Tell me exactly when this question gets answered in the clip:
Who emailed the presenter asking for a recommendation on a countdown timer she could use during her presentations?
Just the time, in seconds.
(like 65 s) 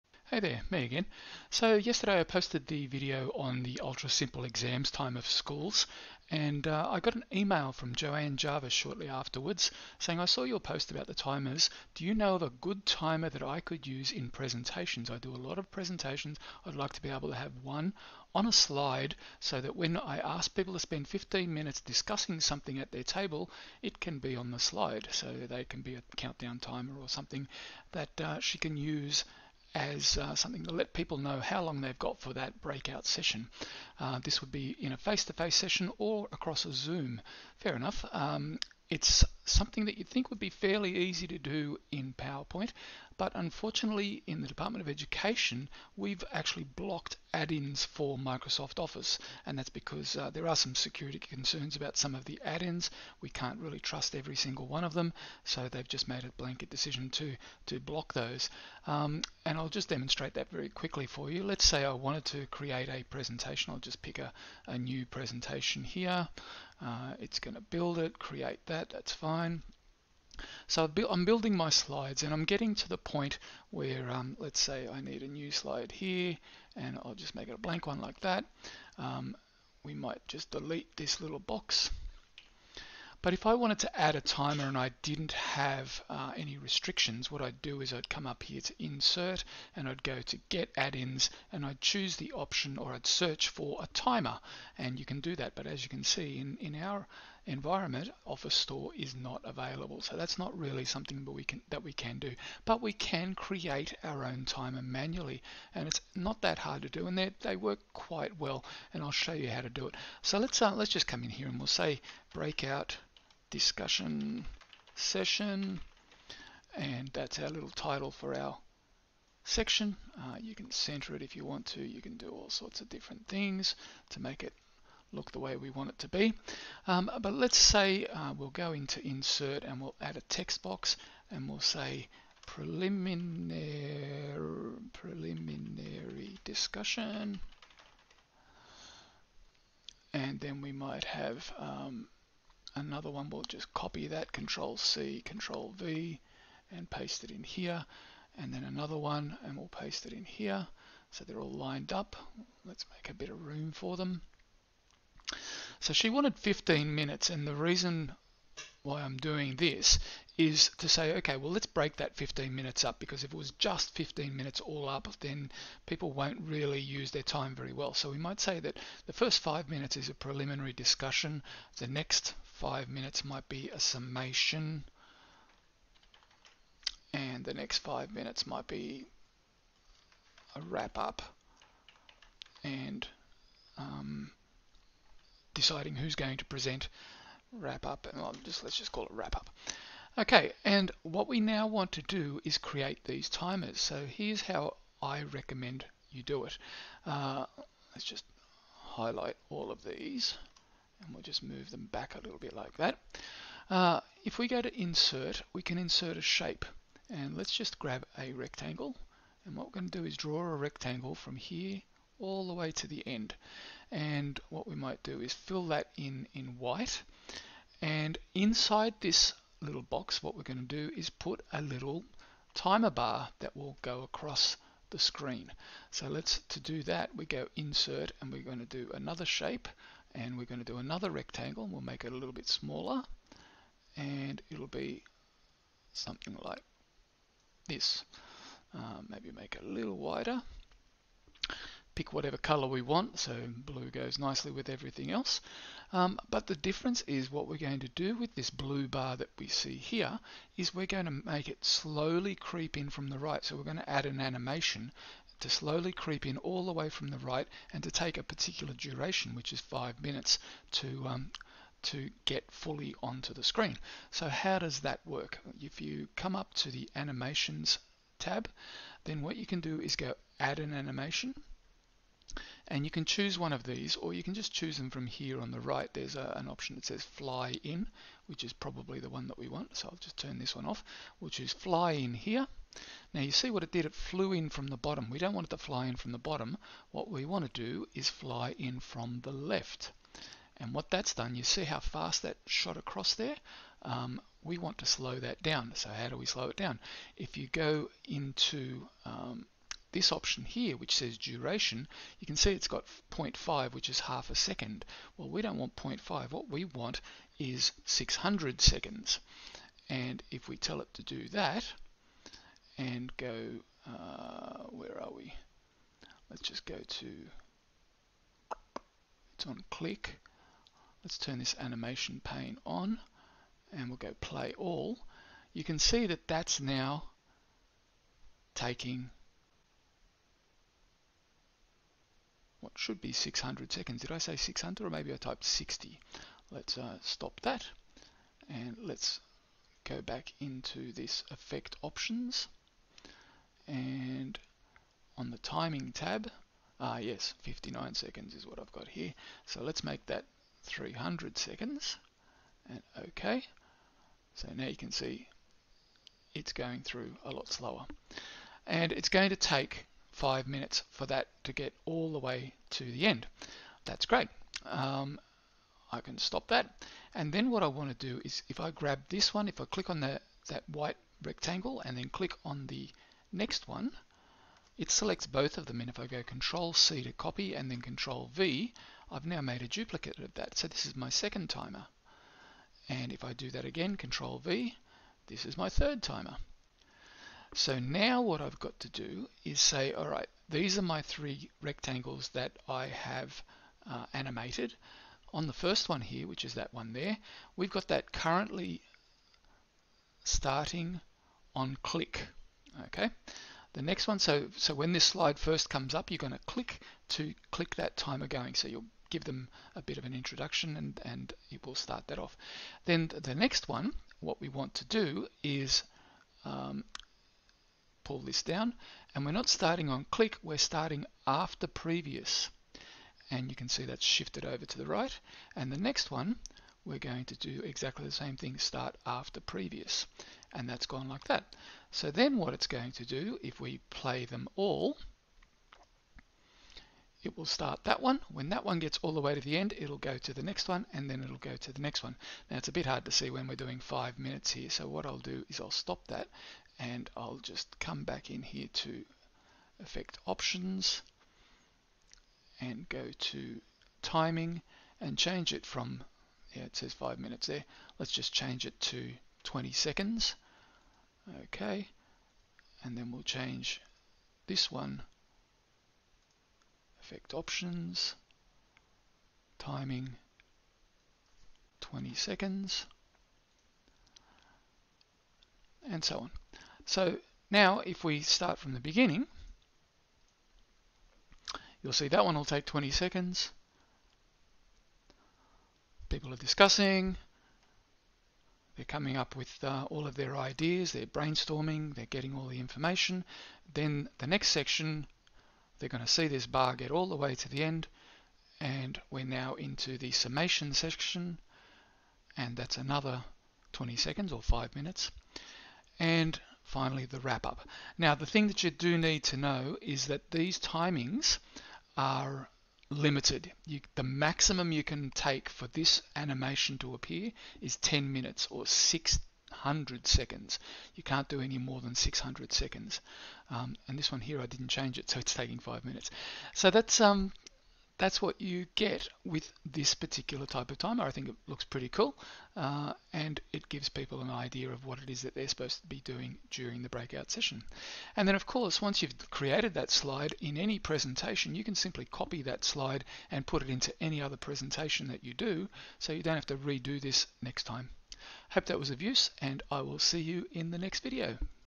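7 s.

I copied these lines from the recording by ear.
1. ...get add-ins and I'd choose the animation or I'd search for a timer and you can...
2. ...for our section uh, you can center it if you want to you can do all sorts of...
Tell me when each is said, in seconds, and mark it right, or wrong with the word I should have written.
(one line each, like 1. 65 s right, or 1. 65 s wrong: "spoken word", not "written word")
1. 90 s wrong: "option", not "animation"
2. 118 s right.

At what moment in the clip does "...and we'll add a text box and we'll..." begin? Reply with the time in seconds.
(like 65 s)
129 s.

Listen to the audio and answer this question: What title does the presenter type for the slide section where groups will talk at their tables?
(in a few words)
Breakout discussion session.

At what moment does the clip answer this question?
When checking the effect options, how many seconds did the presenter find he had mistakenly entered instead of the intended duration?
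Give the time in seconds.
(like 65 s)
347 s.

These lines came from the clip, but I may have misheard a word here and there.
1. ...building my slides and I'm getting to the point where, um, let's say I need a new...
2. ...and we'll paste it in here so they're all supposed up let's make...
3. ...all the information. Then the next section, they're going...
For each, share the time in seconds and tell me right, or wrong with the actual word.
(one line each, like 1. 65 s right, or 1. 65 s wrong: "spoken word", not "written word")
1. 71 s right
2. 149 s wrong: "lined", not "supposed"
3. 492 s right.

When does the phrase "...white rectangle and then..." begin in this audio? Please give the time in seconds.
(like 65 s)
370 s.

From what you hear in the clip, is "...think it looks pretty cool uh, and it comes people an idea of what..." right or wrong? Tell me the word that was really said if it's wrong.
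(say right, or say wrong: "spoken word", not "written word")
wrong: "gives", not "comes".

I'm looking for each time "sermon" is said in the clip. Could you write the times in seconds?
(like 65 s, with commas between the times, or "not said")
not said.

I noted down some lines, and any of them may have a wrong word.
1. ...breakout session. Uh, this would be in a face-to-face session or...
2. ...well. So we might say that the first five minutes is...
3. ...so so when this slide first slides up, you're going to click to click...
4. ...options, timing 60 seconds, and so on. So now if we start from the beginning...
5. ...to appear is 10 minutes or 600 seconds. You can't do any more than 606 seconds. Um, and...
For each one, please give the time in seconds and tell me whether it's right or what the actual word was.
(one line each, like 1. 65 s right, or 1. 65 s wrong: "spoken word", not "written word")
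1. 32 s right
2. 167 s right
3. 404 s wrong: "comes", not "slides"
4. 467 s wrong: "20", not "60"
5. 516 s wrong: "600", not "606".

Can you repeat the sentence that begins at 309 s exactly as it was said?
And if we tell it to do that, and go, uh, where are we?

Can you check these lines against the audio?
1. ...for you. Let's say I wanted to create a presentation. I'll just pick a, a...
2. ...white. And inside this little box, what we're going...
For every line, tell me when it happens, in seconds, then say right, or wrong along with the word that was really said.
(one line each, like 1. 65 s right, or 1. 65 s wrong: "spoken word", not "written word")
1. 61 s right
2. 216 s right.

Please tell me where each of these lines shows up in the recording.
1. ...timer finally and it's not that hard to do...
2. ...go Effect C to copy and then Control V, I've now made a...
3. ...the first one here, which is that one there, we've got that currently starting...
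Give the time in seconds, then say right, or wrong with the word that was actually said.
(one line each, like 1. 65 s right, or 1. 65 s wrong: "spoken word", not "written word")
1. 104 s wrong: "manually", not "finally"
2. 376 s wrong: "Control", not "Effect"
3. 395 s right.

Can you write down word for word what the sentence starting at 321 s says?
Let's turn this animation pane on and we'll go play all.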